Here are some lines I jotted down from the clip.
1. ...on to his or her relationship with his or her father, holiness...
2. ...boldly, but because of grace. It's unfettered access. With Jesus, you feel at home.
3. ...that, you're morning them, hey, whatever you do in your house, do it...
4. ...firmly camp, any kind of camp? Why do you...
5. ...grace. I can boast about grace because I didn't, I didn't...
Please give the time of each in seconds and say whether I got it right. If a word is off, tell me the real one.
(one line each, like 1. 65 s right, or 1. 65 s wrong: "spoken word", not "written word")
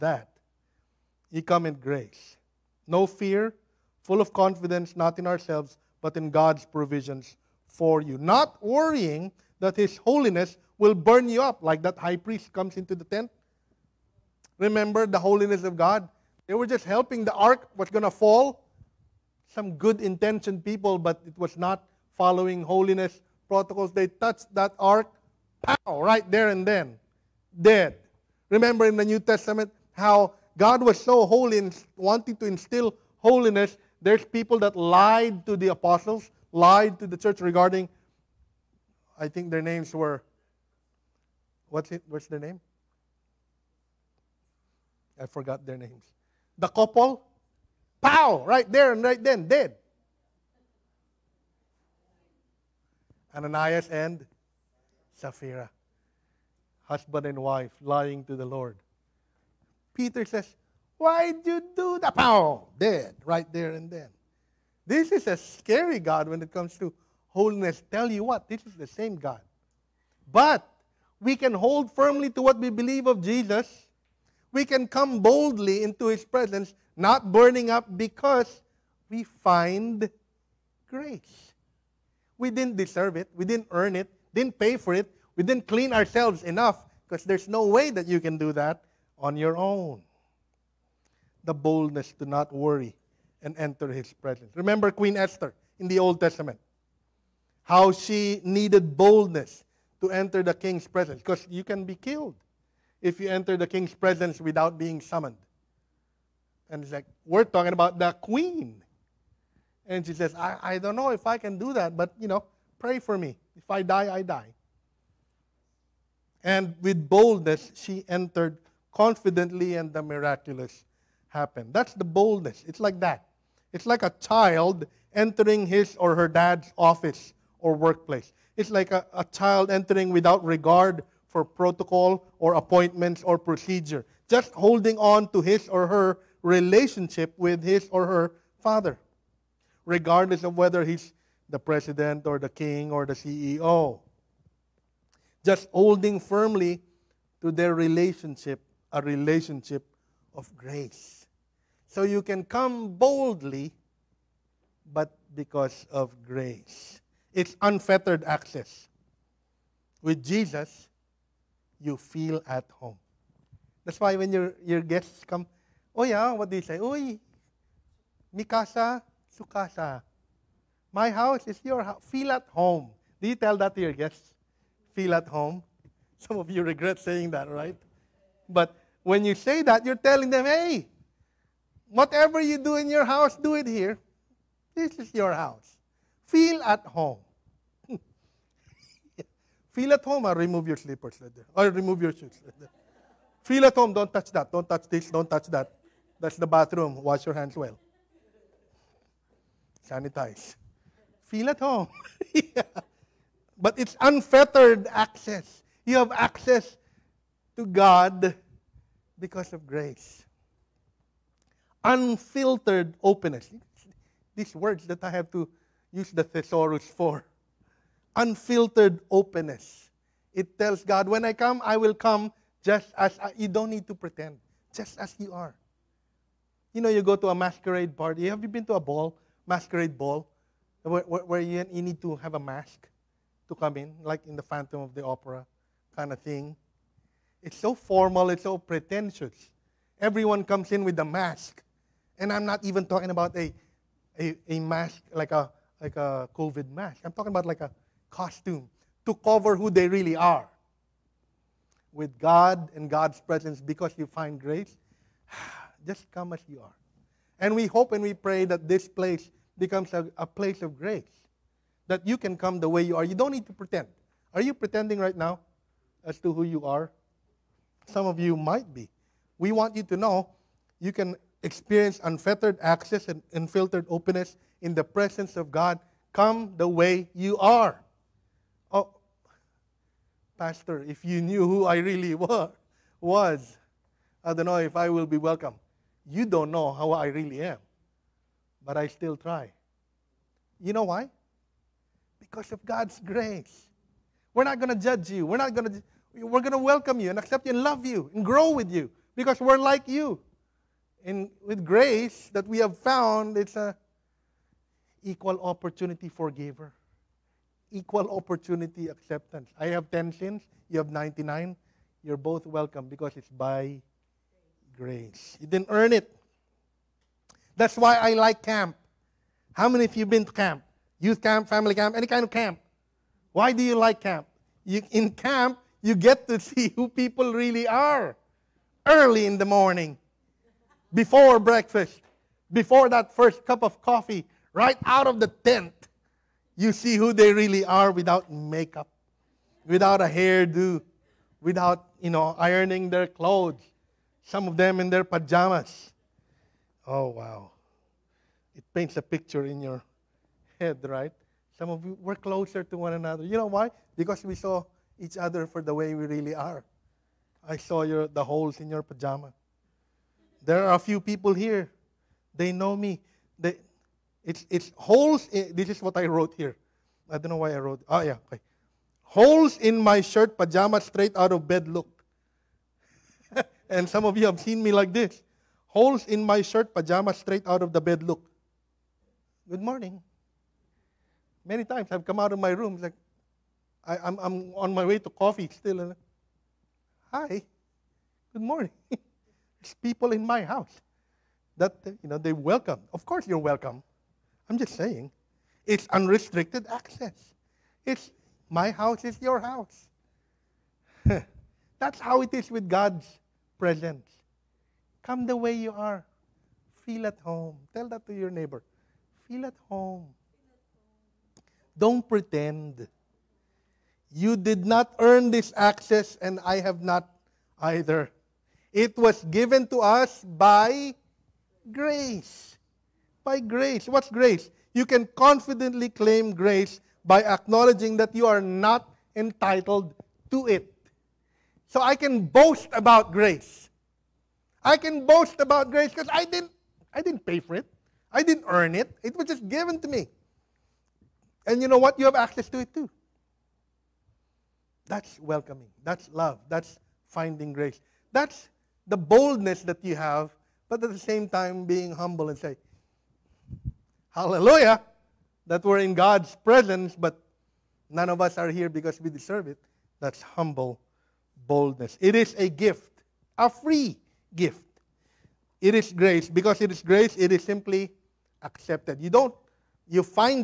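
1. 134 s wrong: "regardless", not "holiness"
2. 152 s right
3. 179 s wrong: "telling", not "morning"
4. 321 s wrong: "family", not "firmly"
5. 433 s right.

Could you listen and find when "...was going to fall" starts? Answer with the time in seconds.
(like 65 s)
17 s.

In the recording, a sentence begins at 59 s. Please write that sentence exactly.
Peter says, Why'd you do that?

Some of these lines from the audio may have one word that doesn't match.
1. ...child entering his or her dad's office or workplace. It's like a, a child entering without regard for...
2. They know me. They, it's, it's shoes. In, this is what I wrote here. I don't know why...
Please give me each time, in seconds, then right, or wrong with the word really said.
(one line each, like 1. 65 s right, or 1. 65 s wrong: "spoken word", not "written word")
1. 124 s right
2. 362 s wrong: "holes", not "shoes".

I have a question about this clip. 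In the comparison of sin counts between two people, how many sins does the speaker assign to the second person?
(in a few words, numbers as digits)
99.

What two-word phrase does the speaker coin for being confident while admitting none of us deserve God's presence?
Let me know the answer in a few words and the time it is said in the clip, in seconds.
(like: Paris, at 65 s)
Humble boldness, at 460 s.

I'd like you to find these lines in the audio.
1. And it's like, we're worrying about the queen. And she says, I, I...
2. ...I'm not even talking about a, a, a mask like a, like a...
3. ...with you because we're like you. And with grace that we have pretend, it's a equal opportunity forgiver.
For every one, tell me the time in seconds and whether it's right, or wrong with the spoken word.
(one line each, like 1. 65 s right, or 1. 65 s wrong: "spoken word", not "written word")
1. 106 s wrong: "talking", not "worrying"
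2. 242 s right
3. 298 s wrong: "found", not "pretend".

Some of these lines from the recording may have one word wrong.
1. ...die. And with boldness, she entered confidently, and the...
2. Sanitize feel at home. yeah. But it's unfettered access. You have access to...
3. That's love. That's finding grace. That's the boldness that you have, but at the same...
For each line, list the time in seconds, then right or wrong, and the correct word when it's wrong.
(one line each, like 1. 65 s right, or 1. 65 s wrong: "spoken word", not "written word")
1. 114 s right
2. 199 s right
3. 445 s right.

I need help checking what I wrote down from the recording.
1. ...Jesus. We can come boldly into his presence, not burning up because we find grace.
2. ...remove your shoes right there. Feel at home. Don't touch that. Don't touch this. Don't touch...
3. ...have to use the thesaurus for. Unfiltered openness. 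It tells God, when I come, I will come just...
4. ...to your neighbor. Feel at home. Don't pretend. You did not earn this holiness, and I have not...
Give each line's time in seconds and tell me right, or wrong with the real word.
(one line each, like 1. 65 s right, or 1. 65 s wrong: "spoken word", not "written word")
1. 73 s right
2. 191 s right
3. 215 s right
4. 408 s wrong: "access", not "holiness".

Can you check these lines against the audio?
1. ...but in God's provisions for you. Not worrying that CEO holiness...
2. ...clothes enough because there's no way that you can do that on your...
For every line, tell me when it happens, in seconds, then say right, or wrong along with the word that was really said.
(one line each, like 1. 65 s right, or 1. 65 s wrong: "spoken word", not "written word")
1. 6 s wrong: "His", not "CEO"
2. 85 s wrong: "ourselves", not "clothes".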